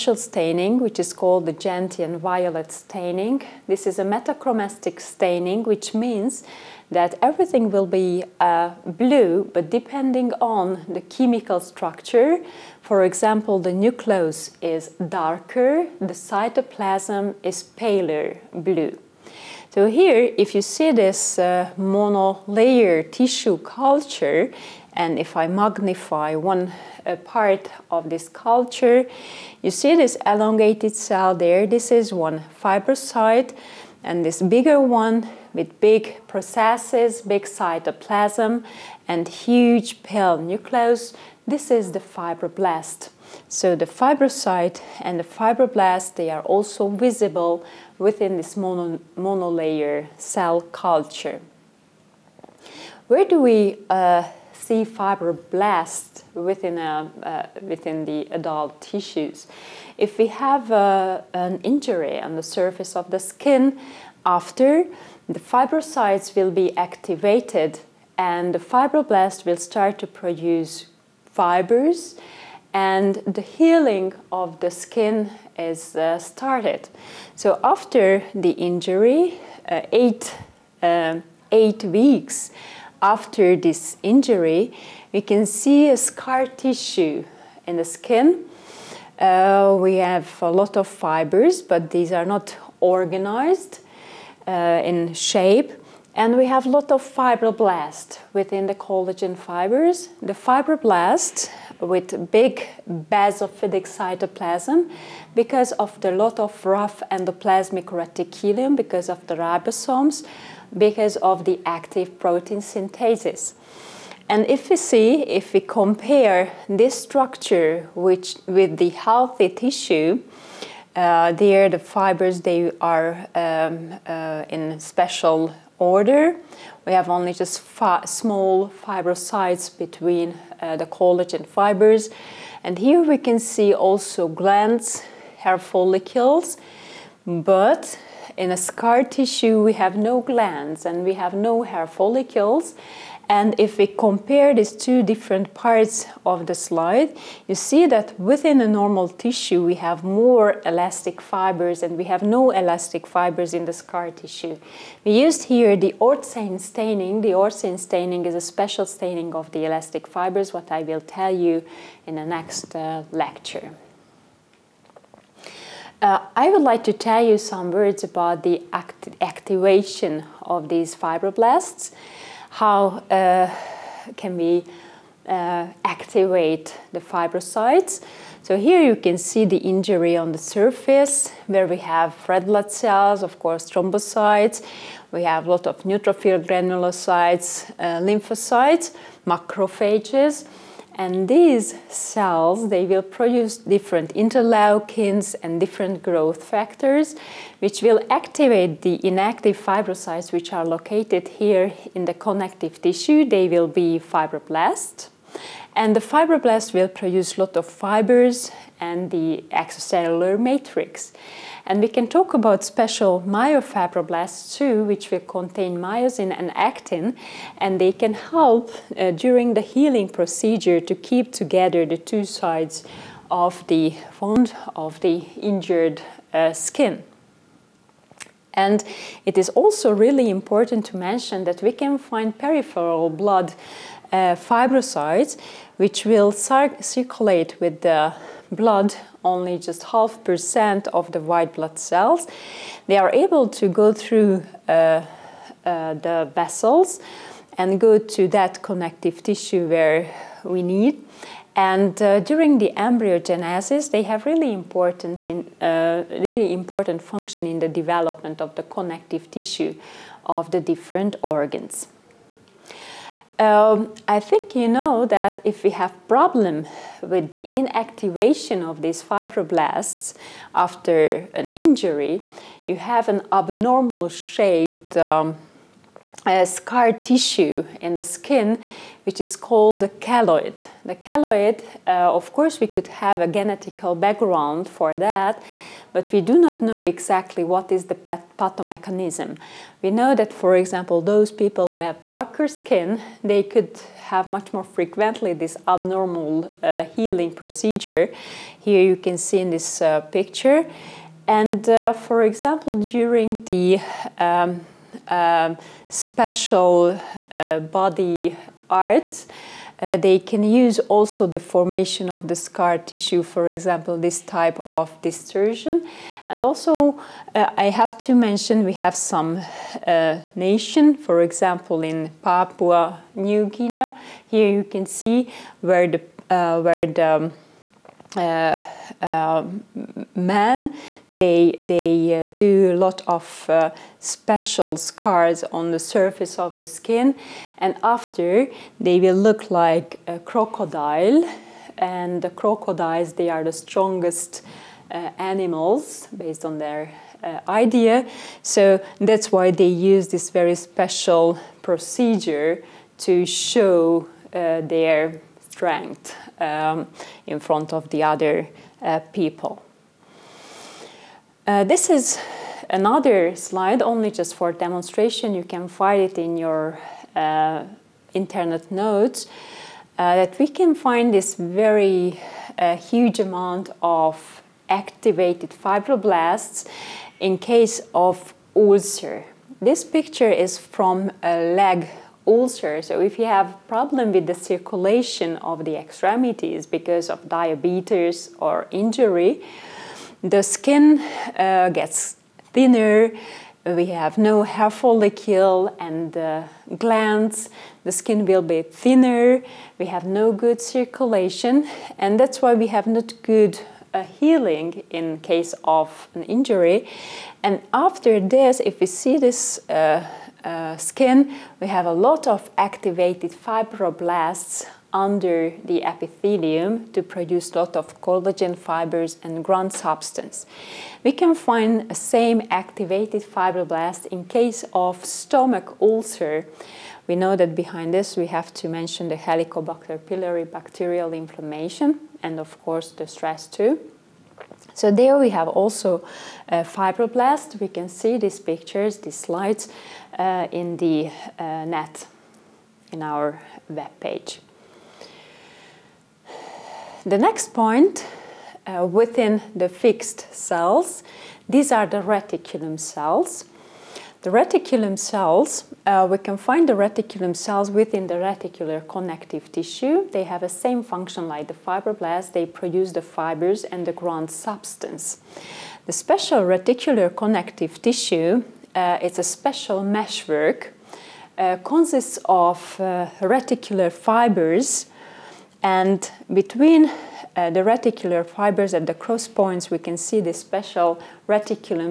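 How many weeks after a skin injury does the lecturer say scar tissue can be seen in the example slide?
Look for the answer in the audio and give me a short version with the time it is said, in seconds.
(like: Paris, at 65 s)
8, at 81 s.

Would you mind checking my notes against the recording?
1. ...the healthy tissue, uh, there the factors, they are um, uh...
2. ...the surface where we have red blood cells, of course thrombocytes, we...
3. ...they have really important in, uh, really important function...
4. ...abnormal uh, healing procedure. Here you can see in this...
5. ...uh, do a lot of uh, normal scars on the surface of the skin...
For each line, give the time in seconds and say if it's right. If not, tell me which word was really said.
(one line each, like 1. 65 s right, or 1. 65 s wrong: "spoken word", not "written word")
1. 118 s wrong: "fibers", not "factors"
2. 180 s right
3. 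253 s right
4. 295 s right
5. 332 s wrong: "special", not "normal".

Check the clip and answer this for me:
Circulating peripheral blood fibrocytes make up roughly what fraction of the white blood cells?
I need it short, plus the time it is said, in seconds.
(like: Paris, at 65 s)
Half percent, at 239 s.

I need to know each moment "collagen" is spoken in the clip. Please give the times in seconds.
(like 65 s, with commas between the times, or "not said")
98 s, 130 s, 418 s.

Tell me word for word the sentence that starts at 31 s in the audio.
This is one fibrocyte and this bigger one with big processes, big cytoplasm and huge pale nucleus.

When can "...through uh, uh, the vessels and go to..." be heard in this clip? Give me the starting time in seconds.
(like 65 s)
243 s.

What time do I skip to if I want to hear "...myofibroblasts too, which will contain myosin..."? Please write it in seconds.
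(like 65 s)
213 s.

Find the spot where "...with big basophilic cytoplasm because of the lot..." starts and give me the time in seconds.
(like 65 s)
101 s.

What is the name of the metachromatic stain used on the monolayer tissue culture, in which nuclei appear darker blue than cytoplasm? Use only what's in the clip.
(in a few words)
Gentian violet.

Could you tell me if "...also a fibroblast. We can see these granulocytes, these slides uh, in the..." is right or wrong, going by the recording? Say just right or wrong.
wrong.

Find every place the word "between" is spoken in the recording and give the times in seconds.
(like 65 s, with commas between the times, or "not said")
129 s, 476 s.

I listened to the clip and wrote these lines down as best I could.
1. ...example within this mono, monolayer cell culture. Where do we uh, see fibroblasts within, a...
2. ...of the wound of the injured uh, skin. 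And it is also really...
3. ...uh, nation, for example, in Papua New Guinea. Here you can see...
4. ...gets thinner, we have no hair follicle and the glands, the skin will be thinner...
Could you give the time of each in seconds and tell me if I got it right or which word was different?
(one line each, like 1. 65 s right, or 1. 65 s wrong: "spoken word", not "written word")
1. 46 s wrong: "visible", not "example"
2. 223 s right
3. 319 s right
4. 391 s right.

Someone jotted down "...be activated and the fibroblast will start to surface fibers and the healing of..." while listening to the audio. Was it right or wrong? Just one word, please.
wrong.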